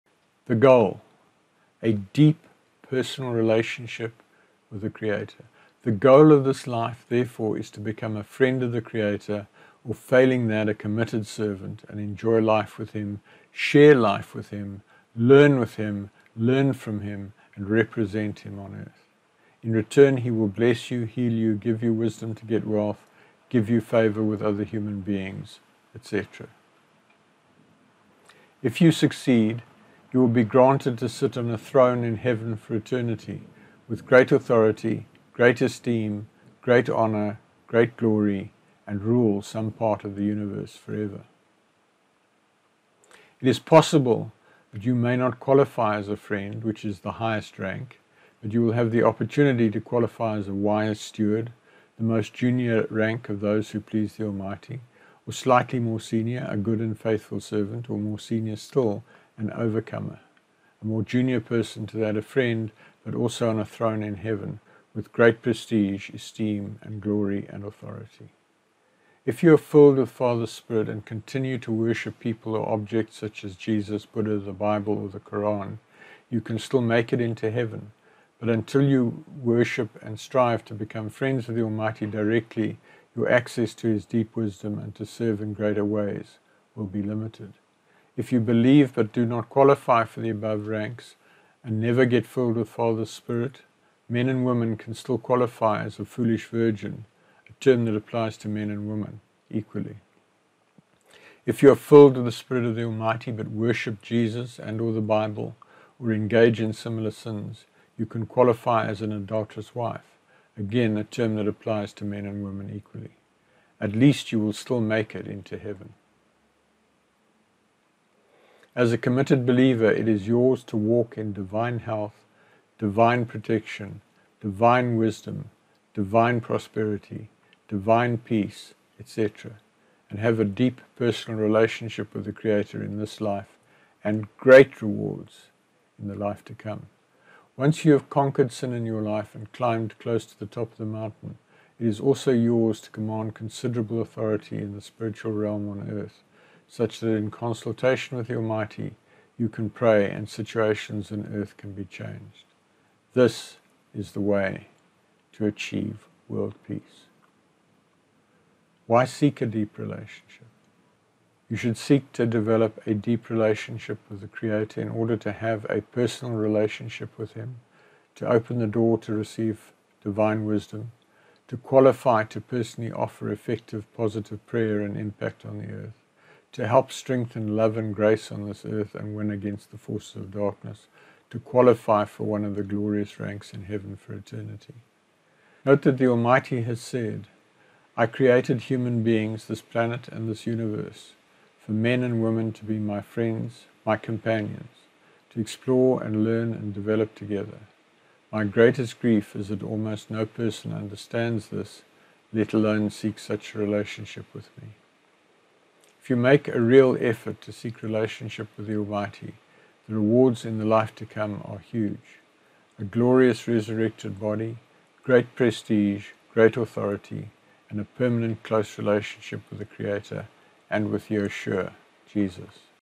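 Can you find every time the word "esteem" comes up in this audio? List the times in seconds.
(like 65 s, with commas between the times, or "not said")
35 s, 66 s.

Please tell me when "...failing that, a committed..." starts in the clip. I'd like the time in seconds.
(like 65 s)
9 s.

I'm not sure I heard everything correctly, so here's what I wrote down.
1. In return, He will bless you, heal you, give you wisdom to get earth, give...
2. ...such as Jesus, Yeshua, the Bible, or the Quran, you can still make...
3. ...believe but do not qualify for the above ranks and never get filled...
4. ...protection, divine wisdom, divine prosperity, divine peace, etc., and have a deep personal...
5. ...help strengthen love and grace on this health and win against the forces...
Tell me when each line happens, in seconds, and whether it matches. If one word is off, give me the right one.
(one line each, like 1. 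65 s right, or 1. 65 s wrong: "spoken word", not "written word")
1. 19 s wrong: "wealth", not "earth"
2. 73 s wrong: "Buddha", not "Yeshua"
3. 88 s right
4. 123 s right
5. 176 s wrong: "earth", not "health".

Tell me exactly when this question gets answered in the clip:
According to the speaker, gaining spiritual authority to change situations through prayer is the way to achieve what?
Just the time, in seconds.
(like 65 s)
156 s.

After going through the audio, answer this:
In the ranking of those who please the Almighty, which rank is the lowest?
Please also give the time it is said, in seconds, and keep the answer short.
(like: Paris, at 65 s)
wise steward, at 50 s.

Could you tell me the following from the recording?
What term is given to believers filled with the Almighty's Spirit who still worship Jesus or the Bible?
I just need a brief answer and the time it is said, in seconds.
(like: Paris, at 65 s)
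adulterous wife, at 109 s.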